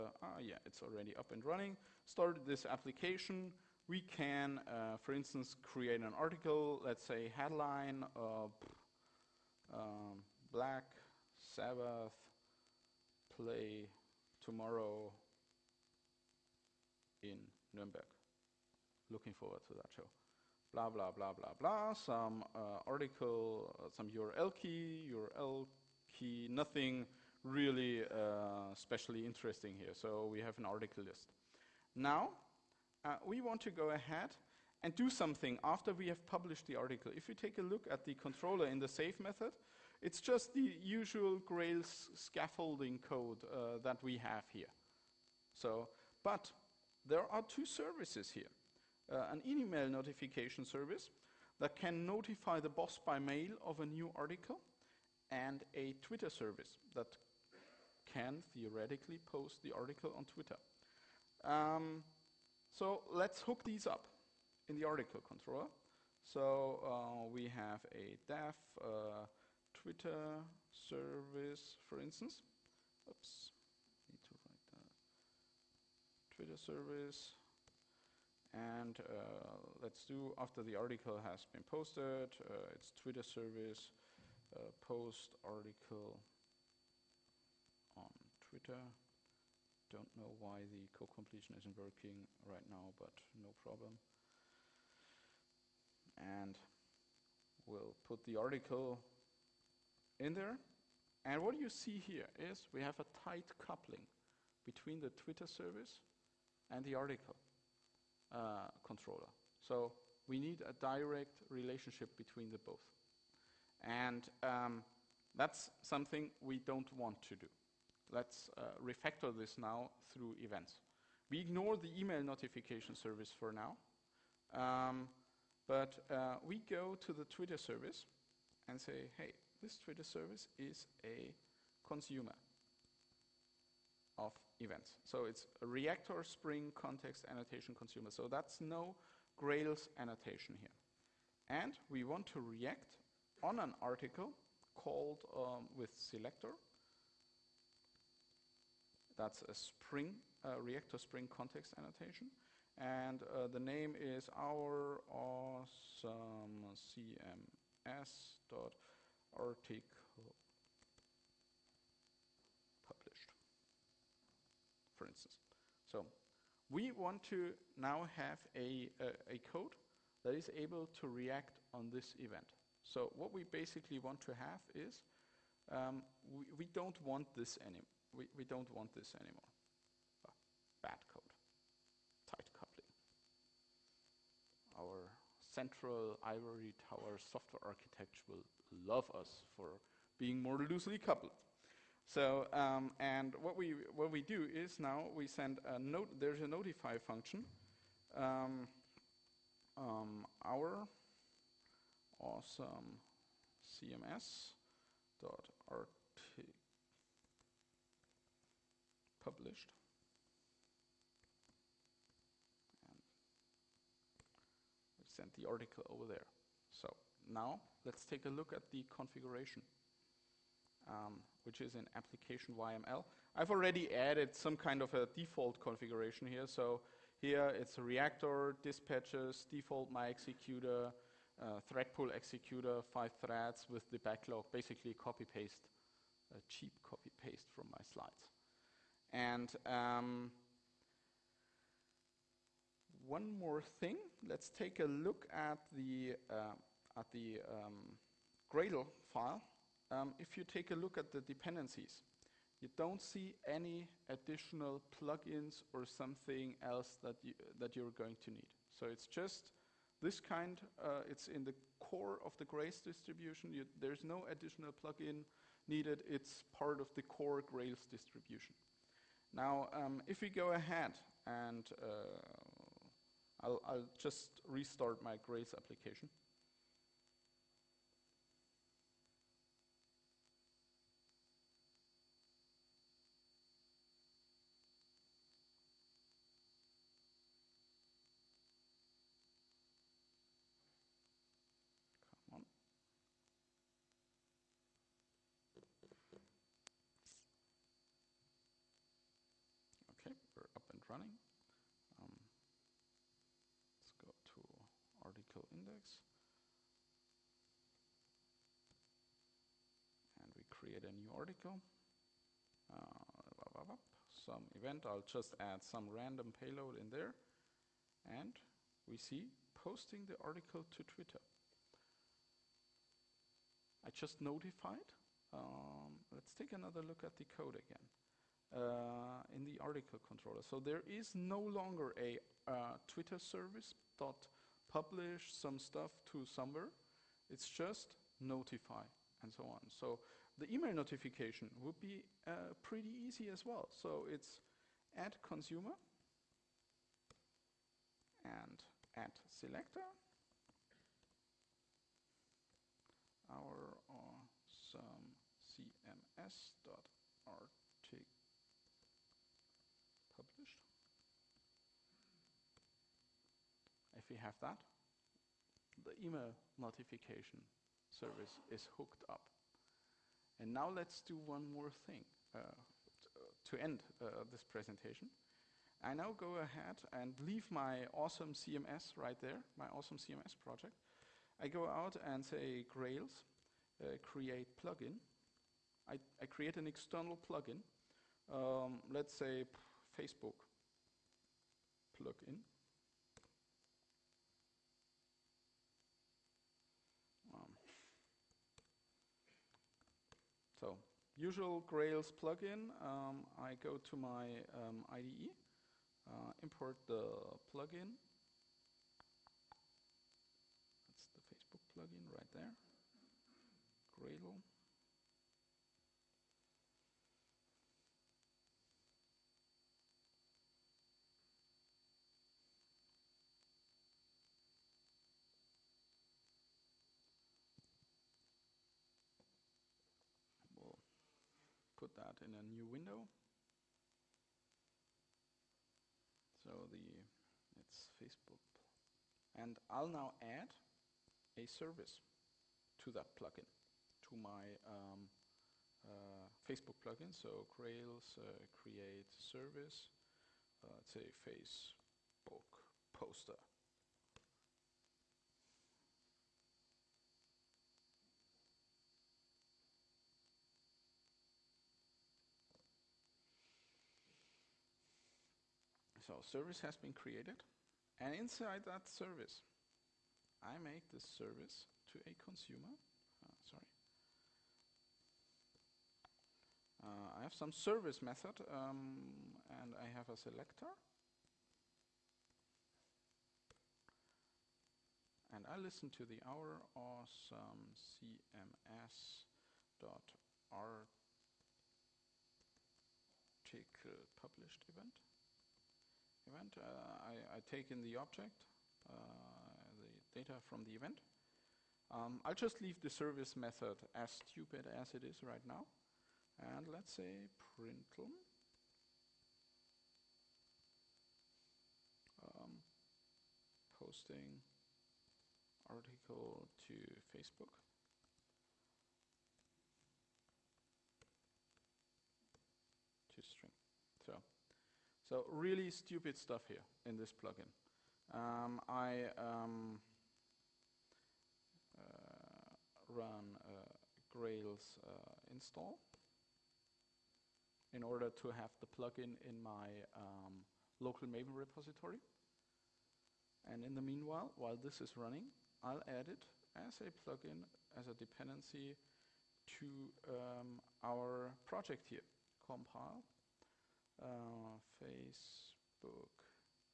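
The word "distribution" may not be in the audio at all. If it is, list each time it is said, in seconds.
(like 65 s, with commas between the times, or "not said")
262 s, 267 s.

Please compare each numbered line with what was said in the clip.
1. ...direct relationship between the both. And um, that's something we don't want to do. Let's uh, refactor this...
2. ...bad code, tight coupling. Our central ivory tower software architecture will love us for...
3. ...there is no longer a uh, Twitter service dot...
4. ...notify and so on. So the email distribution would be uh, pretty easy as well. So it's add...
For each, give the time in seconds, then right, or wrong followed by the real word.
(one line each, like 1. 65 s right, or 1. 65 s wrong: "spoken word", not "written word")
1. 110 s right
2. 180 s right
3. 330 s right
4. 338 s wrong: "notification", not "distribution".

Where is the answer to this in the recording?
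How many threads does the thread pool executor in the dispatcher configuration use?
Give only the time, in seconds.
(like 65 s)
232 s.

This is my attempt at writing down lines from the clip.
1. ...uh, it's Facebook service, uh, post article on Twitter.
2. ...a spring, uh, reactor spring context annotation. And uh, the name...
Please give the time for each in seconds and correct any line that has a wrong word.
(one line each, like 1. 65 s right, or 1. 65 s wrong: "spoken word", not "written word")
1. 82 s wrong: "Twitter", not "Facebook"
2. 149 s right.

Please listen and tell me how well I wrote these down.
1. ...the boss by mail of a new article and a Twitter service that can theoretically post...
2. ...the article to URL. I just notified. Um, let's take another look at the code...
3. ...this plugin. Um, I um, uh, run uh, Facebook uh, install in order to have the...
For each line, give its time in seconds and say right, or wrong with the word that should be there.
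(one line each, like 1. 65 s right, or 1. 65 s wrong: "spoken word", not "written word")
1. 52 s right
2. 320 s wrong: "Twitter", not "URL"
3. 526 s wrong: "Grails", not "Facebook".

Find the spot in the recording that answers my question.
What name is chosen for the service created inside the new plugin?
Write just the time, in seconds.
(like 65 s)
451 s.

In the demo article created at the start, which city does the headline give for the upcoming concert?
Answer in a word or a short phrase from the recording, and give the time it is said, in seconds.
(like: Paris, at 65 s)
Nuremberg, at 17 s.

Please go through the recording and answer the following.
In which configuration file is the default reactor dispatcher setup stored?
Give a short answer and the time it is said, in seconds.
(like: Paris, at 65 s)
application YML, at 221 s.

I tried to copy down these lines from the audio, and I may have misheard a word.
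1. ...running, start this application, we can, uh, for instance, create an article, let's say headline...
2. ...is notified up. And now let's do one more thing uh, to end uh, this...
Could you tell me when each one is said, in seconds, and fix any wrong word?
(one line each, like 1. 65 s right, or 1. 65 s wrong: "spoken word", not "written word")
1. 1 s right
2. 368 s wrong: "hooked", not "notified".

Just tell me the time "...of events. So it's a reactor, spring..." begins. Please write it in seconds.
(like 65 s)
134 s.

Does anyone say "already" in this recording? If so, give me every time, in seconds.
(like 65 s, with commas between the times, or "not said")
0 s, 223 s.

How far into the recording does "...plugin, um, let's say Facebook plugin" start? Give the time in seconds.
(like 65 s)
387 s.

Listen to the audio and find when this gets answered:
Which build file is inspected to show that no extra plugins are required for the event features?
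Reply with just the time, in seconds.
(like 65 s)
248 s.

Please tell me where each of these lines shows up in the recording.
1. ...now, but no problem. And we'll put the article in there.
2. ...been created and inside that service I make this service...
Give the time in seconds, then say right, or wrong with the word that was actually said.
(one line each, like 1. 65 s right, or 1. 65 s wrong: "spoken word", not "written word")
1. 92 s right
2. 466 s right.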